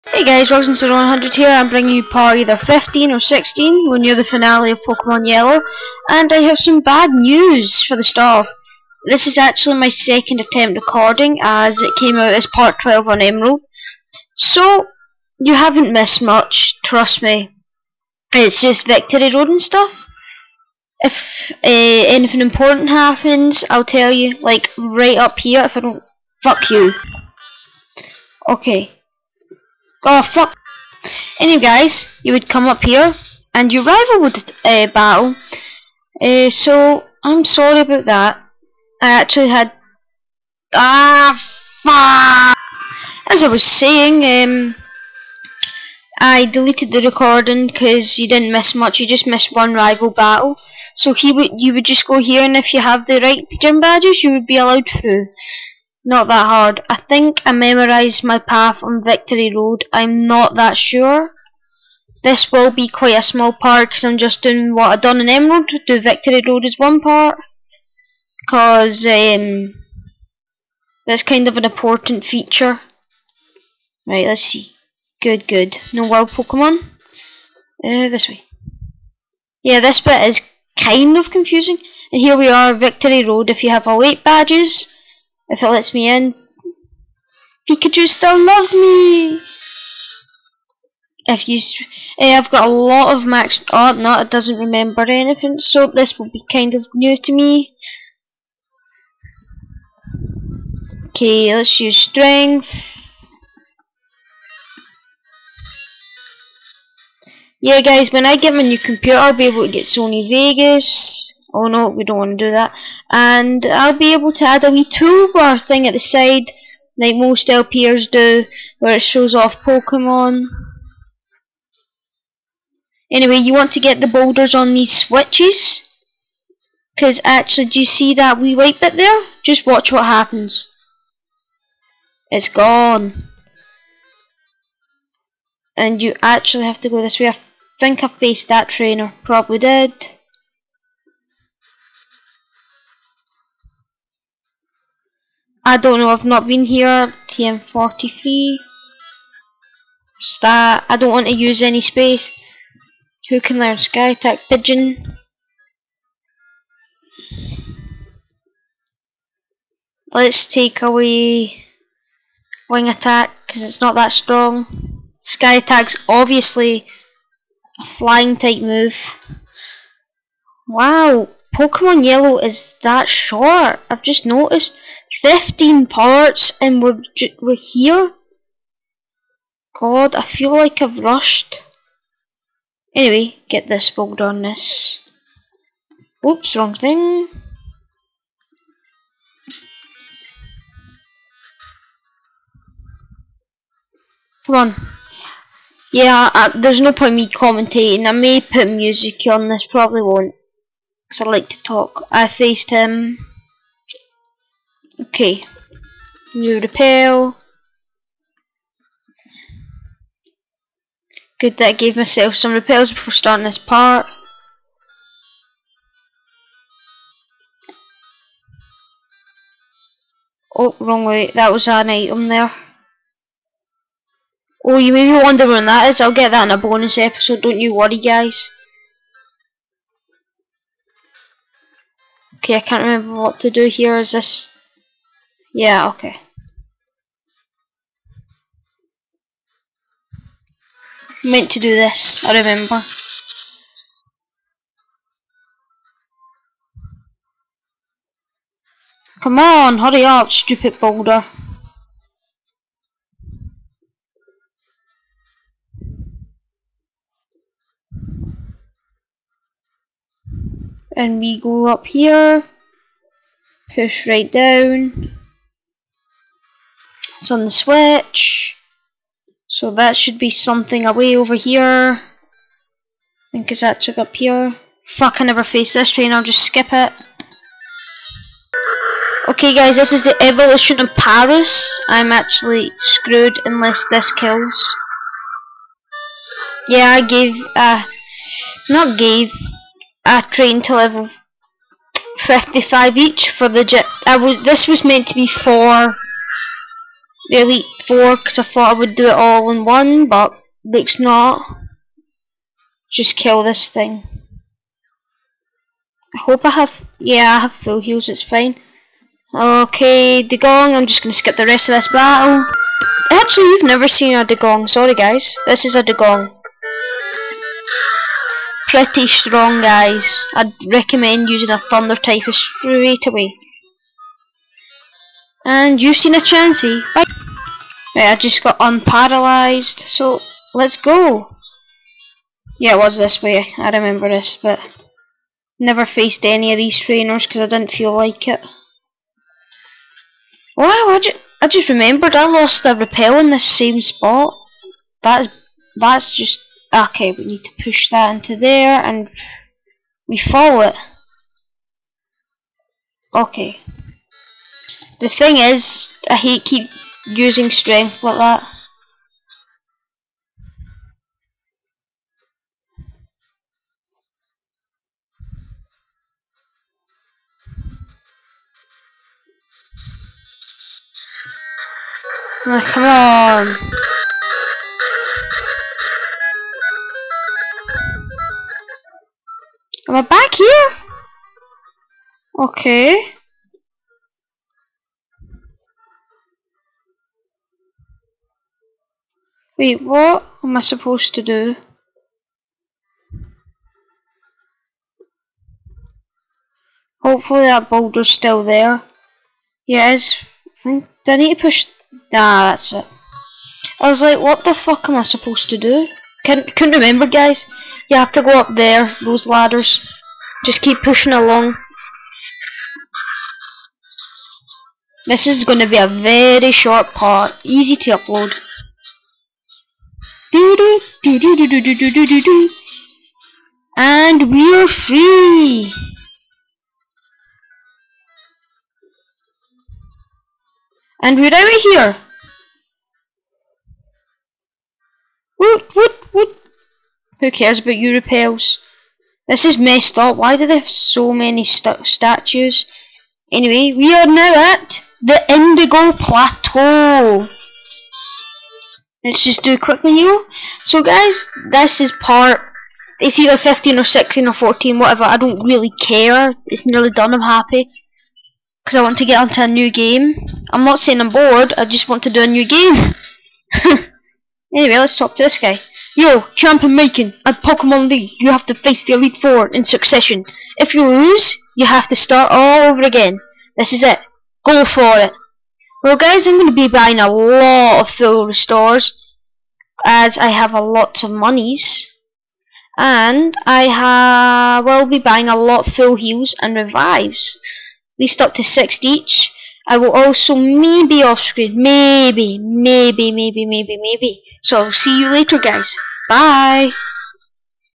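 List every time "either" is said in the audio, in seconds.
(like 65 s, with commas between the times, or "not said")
2 s, 453 s.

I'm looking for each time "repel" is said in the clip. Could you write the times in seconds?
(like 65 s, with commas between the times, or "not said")
206 s, 212 s, 342 s.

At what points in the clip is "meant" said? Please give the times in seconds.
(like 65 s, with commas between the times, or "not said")
241 s, 294 s.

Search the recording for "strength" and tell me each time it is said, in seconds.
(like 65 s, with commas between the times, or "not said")
101 s, 357 s.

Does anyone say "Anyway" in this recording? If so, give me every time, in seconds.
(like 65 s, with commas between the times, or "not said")
31 s, 123 s, 182 s, 443 s, 464 s.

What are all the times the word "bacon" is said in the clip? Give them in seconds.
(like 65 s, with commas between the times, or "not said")
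not said.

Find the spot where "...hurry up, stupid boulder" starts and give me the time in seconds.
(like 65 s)
249 s.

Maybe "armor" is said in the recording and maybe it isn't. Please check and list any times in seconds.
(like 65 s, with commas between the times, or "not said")
not said.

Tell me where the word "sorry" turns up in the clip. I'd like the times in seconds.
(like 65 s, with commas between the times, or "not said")
37 s, 314 s.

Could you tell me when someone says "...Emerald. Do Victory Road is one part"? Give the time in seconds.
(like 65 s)
65 s.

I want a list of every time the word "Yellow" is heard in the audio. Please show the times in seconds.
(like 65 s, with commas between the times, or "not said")
5 s, 172 s.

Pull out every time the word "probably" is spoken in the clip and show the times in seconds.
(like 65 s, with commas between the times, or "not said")
139 s, 199 s.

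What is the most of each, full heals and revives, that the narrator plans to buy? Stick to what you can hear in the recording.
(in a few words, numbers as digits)
6.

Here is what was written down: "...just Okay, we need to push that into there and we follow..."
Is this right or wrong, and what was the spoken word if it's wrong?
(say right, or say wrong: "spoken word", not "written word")
right.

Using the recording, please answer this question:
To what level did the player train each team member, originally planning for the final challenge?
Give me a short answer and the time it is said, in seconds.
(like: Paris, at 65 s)
55, at 290 s.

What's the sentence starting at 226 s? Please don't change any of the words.
I'll get that in a bonus episode, don't you worry, guys.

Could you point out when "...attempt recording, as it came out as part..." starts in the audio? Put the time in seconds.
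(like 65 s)
10 s.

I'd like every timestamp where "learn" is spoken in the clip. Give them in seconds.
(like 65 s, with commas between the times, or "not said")
153 s.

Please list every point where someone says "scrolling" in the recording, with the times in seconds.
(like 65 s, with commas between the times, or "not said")
not said.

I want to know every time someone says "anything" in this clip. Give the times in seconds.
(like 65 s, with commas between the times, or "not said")
22 s, 95 s.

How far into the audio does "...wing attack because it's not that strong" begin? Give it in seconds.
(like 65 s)
162 s.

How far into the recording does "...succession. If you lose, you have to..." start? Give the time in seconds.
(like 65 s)
469 s.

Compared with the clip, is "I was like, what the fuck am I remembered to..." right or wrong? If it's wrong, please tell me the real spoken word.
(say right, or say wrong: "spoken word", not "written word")
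wrong: "supposed", not "remembered".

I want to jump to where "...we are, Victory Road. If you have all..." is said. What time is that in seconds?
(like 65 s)
82 s.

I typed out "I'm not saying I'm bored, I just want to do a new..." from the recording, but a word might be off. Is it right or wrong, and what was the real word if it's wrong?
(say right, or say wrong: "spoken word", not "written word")
right.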